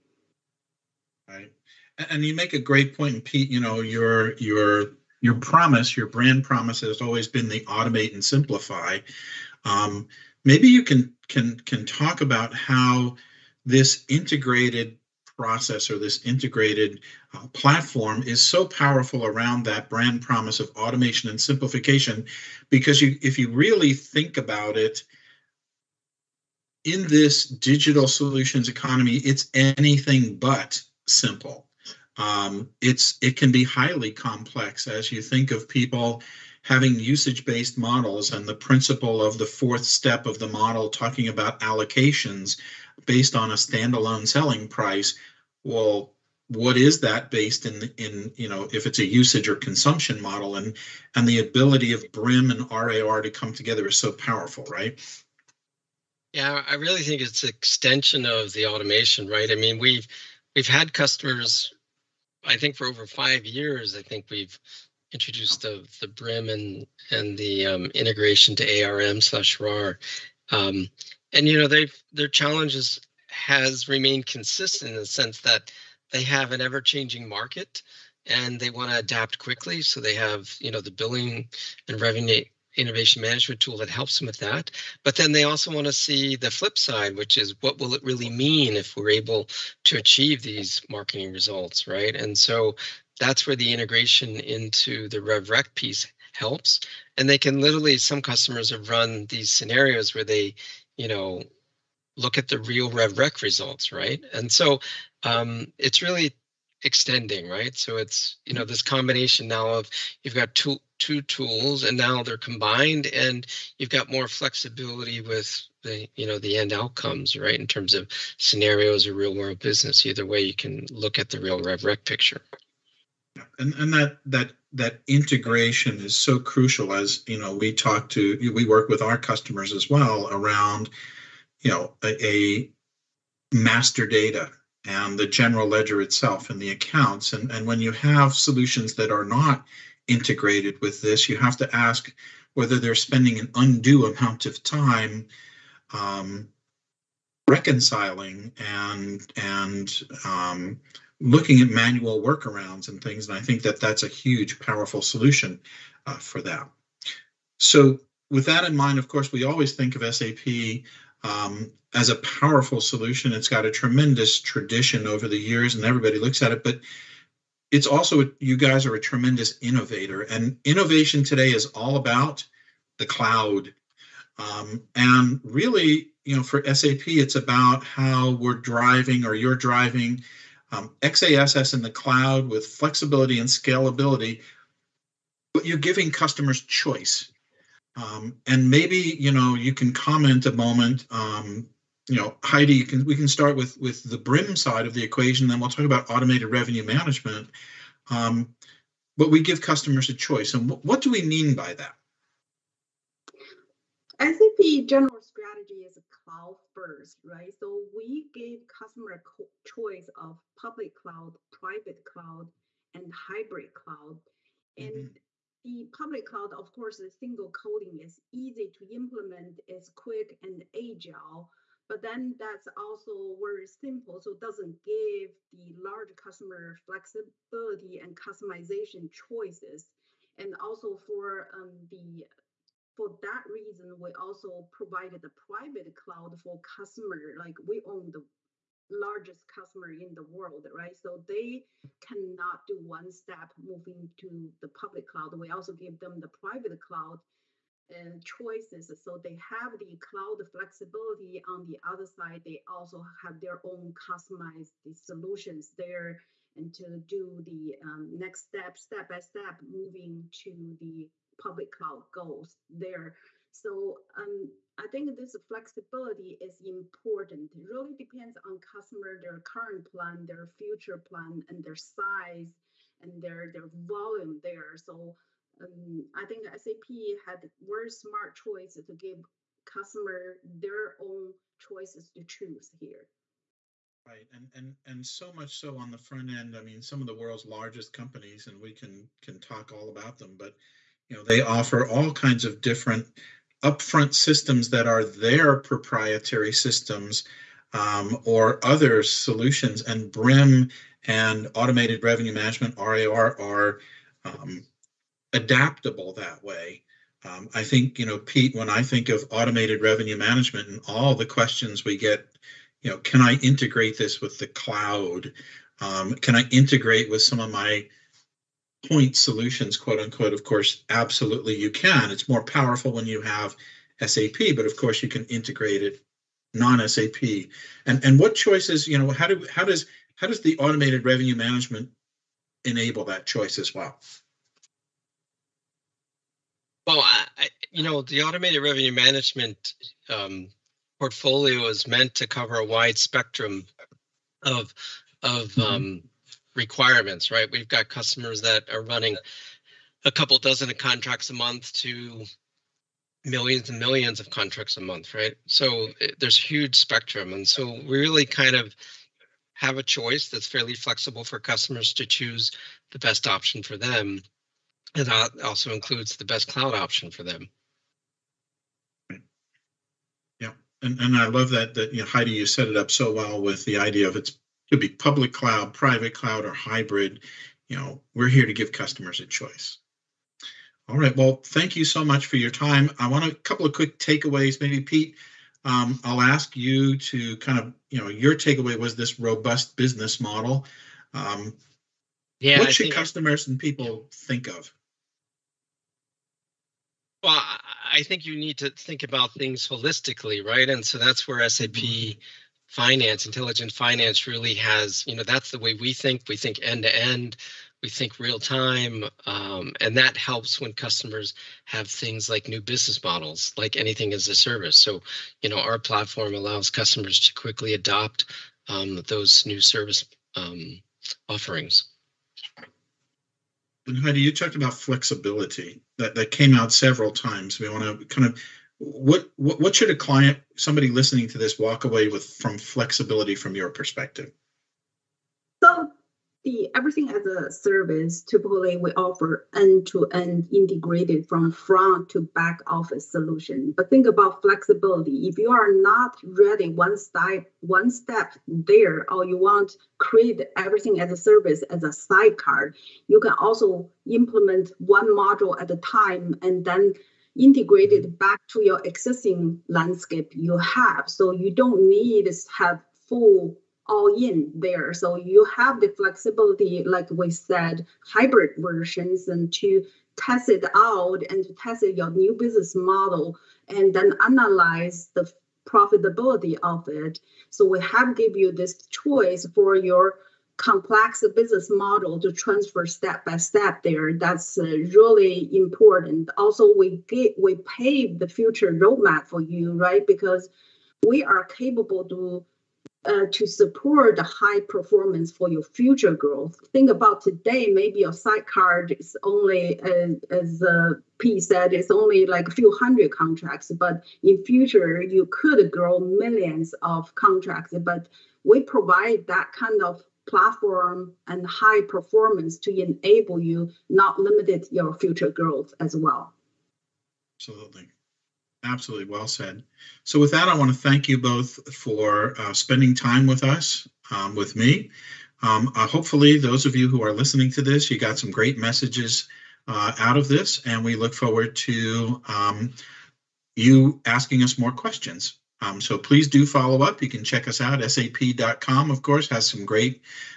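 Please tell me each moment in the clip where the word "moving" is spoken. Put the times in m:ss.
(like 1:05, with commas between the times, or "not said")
4:03, 4:19.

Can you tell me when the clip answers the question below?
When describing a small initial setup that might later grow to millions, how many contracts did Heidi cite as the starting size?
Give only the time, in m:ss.
8:22.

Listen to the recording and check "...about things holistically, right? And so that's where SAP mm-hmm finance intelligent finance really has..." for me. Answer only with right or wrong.
right.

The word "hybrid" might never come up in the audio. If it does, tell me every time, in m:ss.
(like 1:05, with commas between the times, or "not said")
3:33, 6:16, 7:48.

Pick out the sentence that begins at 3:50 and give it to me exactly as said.
And also for um, the for that reason, we also provided the private cloud for customer.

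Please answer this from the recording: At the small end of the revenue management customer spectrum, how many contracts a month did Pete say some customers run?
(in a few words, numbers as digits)
a couple dozen.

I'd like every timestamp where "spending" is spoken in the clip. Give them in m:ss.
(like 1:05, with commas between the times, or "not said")
2:22, 8:42.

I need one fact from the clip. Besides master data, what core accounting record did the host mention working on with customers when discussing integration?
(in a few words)
the general ledger.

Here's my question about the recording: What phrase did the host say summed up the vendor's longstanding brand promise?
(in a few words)
automate and simplify.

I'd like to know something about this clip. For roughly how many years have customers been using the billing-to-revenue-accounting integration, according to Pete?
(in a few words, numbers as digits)
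over five years.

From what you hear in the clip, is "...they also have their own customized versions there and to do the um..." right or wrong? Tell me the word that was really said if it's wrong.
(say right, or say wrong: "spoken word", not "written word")
wrong: "solutions", not "versions".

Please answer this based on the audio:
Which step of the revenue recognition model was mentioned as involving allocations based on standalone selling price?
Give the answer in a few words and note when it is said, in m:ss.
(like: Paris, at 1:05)
the fourth step, at 0:39.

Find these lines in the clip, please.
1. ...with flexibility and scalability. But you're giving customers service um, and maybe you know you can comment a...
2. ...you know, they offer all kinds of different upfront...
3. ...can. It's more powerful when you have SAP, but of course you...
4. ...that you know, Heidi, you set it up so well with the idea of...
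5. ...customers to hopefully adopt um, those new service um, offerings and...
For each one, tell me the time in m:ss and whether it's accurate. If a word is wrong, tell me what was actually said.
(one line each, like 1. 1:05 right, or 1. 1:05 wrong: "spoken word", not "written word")
1. 3:02 wrong: "choice", not "service"
2. 4:51 right
3. 5:21 right
4. 6:11 right
5. 6:56 wrong: "quickly", not "hopefully".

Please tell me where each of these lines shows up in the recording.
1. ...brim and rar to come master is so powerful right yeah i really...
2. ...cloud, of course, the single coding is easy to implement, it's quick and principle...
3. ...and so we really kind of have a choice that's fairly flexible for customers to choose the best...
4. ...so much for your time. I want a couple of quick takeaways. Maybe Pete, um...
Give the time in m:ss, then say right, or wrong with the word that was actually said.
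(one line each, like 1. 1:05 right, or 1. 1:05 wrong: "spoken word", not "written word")
1. 0:52 wrong: "together", not "master"
2. 3:36 wrong: "agile", not "principle"
3. 5:57 right
4. 6:21 right.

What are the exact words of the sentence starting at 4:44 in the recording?
Right, and and and so much so on the front end.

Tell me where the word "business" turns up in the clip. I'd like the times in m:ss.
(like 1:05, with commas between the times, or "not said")
1:59, 6:29, 6:52, 7:52, 8:01.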